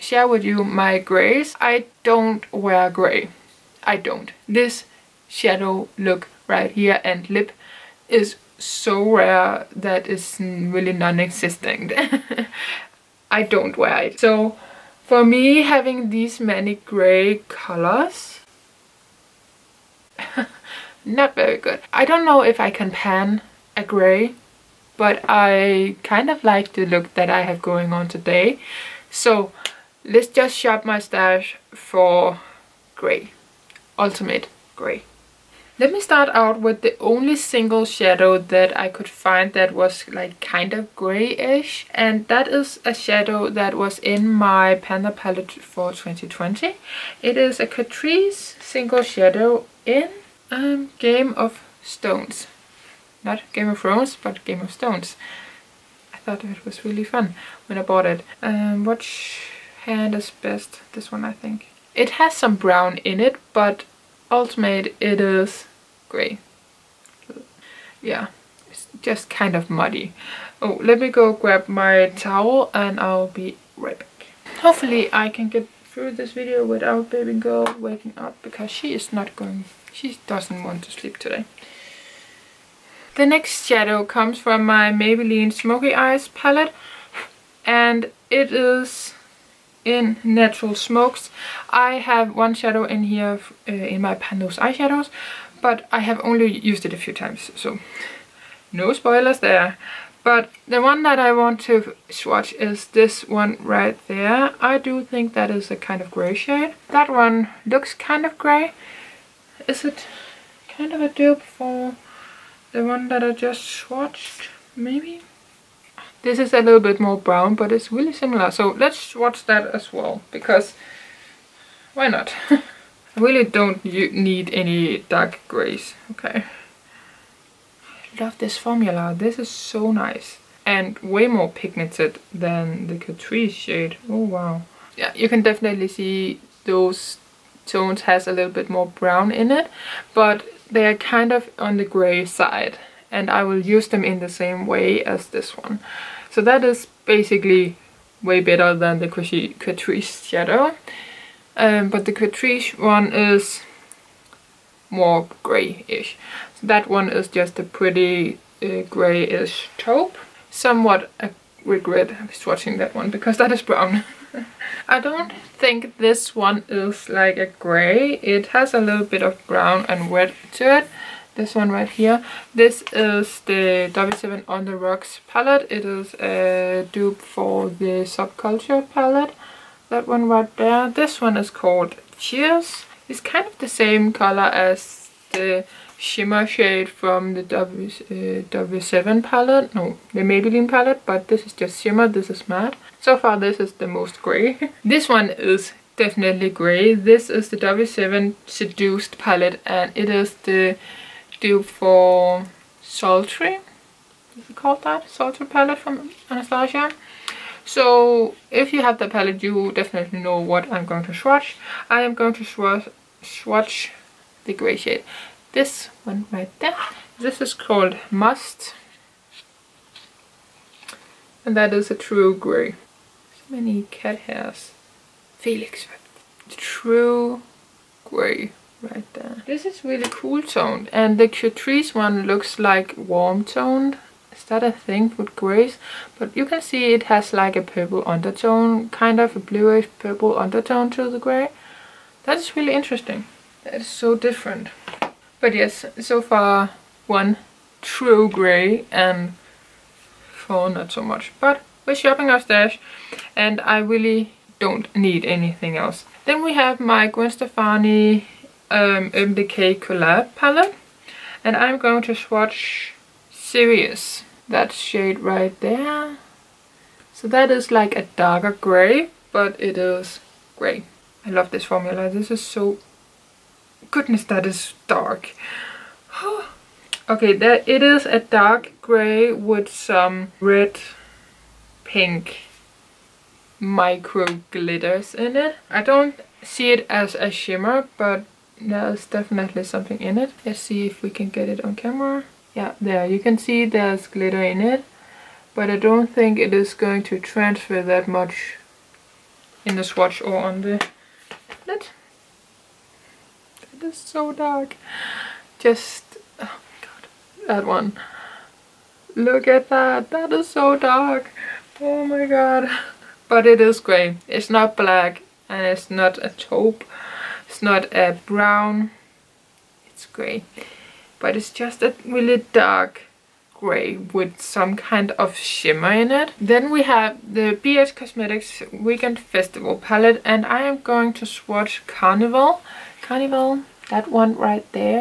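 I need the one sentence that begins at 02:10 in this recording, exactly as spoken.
And way more pigmented than the Catrice shade.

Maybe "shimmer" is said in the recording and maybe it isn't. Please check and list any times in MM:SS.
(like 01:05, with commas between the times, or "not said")
03:05, 03:11, 04:47, 05:25.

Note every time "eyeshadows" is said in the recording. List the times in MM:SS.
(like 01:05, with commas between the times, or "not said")
01:34.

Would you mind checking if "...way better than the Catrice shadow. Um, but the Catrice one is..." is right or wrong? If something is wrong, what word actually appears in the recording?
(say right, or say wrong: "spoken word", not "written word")
right.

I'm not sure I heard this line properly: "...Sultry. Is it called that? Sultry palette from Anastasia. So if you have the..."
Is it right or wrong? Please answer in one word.
right.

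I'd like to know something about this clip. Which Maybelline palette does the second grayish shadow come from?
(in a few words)
Smoky Eyes.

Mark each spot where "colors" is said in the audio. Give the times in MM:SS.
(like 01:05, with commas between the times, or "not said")
00:17, 03:04.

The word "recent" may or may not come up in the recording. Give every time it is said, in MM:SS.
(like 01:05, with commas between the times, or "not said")
not said.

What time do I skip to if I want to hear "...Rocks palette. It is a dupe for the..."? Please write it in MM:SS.
02:54.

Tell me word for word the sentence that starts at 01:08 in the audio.
Yeah, it's just kind of muddy.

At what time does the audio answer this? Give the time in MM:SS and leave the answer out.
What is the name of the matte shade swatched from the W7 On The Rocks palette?
03:02.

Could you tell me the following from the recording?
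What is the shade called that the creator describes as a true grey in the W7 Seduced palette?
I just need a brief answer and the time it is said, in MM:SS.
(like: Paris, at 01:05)
Must, at 03:38.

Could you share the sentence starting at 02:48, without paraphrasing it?
It has a little bit of brown and red to it.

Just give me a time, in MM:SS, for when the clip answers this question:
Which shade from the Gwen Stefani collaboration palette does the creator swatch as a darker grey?
04:23.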